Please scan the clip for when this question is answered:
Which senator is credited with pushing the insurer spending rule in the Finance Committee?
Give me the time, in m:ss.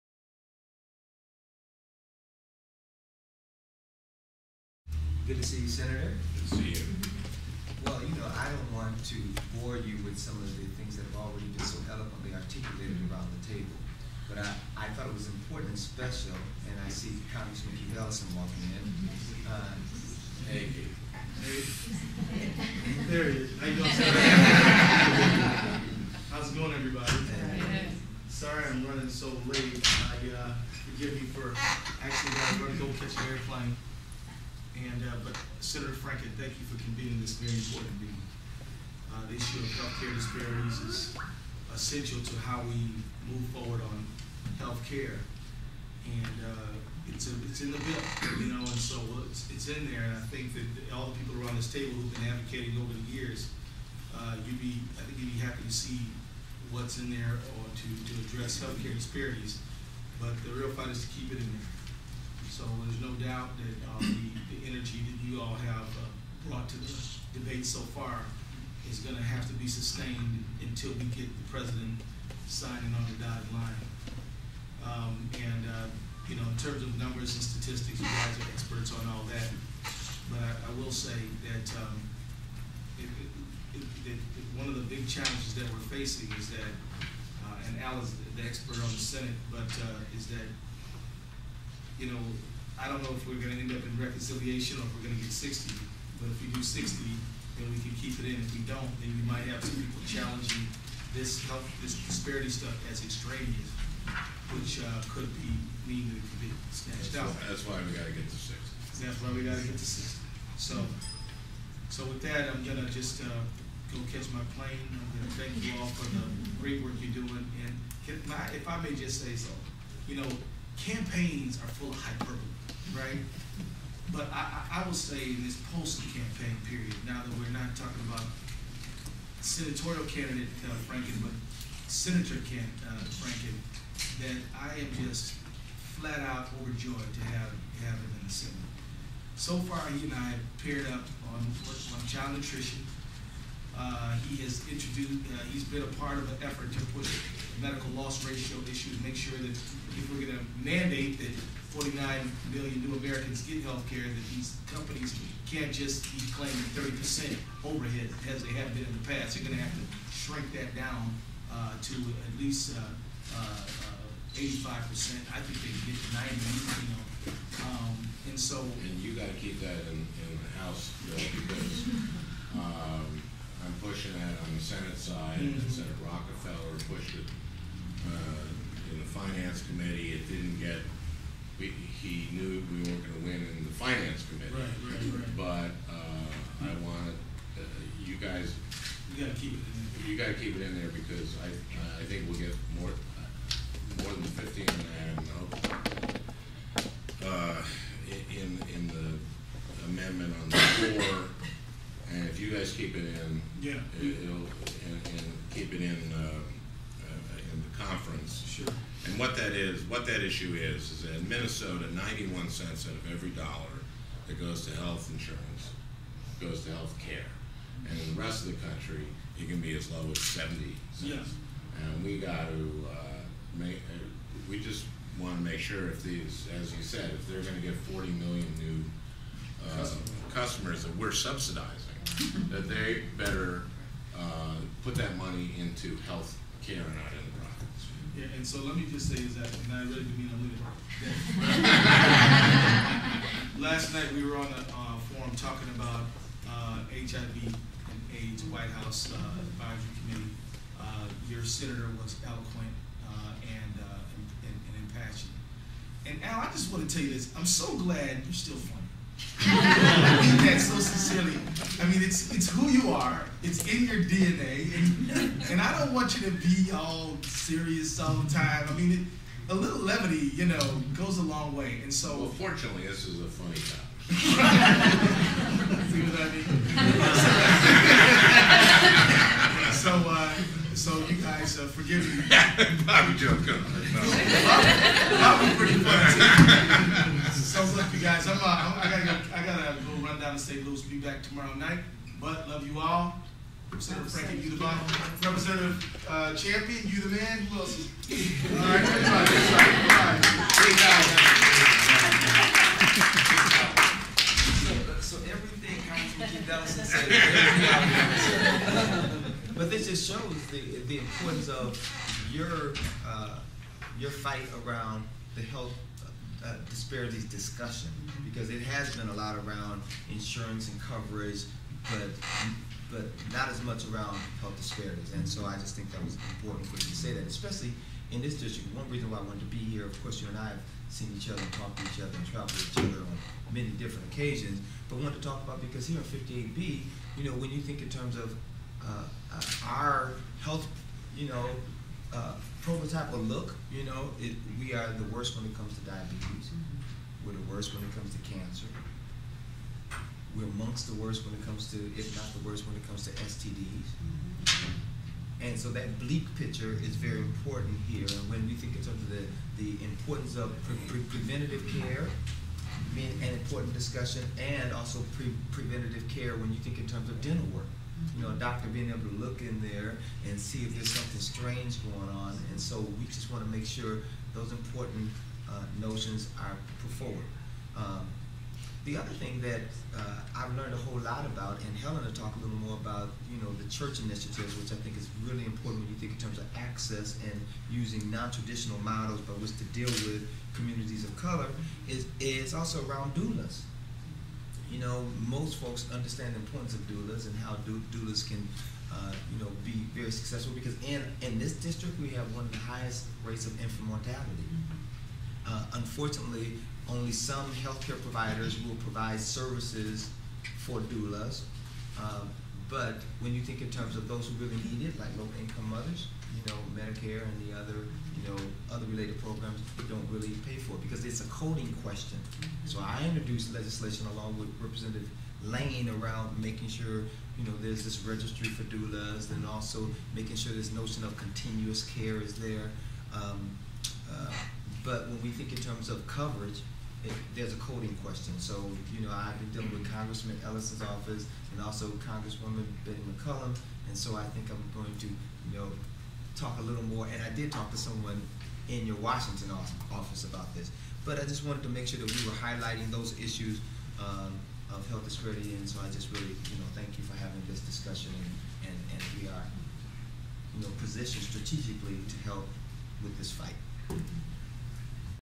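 2:55.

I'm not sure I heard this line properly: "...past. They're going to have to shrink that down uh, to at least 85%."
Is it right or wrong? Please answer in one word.
right.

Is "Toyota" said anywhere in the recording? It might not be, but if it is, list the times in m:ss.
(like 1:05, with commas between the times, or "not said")
not said.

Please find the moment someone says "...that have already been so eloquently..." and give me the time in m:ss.
0:10.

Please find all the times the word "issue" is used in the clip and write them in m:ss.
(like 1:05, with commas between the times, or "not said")
0:39, 2:28, 3:30, 7:33.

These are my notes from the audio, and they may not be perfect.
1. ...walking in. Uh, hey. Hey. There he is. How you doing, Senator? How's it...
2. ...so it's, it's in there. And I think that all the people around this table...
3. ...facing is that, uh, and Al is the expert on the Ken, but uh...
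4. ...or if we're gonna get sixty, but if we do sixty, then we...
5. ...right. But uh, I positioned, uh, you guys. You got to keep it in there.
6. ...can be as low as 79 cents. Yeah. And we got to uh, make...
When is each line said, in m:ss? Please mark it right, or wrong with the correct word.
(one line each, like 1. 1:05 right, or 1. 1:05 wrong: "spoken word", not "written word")
1. 0:18 right
2. 0:48 right
3. 1:25 wrong: "Senate", not "Ken"
4. 1:34 right
5. 3:05 wrong: "wanted", not "positioned"
6. 3:39 wrong: "70", not "79".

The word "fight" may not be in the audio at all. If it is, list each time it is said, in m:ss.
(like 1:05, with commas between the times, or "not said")
1:00, 5:14, 7:43.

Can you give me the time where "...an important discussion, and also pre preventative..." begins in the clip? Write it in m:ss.
6:03.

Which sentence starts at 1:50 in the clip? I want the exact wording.
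So, so with that, I'm gonna just, uh, go catch my plane.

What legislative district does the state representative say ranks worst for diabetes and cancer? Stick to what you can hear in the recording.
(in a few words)
58B.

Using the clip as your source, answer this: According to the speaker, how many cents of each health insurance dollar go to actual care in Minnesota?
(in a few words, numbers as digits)
91 cents.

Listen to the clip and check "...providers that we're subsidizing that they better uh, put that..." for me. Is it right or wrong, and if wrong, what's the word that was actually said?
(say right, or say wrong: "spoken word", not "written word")
wrong: "customers", not "providers".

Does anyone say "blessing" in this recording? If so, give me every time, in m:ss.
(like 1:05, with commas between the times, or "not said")
not said.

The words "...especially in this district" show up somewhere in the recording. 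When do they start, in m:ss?
5:27.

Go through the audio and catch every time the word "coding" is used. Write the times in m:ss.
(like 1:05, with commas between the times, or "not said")
7:01, 7:17.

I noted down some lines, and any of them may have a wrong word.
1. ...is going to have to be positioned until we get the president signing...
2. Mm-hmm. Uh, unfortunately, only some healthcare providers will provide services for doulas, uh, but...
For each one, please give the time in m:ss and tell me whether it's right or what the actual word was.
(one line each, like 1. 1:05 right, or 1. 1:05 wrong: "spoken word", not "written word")
1. 1:08 wrong: "sustained", not "positioned"
2. 6:44 right.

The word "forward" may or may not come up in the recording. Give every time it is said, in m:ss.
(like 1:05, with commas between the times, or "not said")
0:43, 6:16.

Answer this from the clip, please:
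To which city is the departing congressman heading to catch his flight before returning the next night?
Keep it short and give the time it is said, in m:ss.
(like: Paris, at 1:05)
St. Louis, at 4:50.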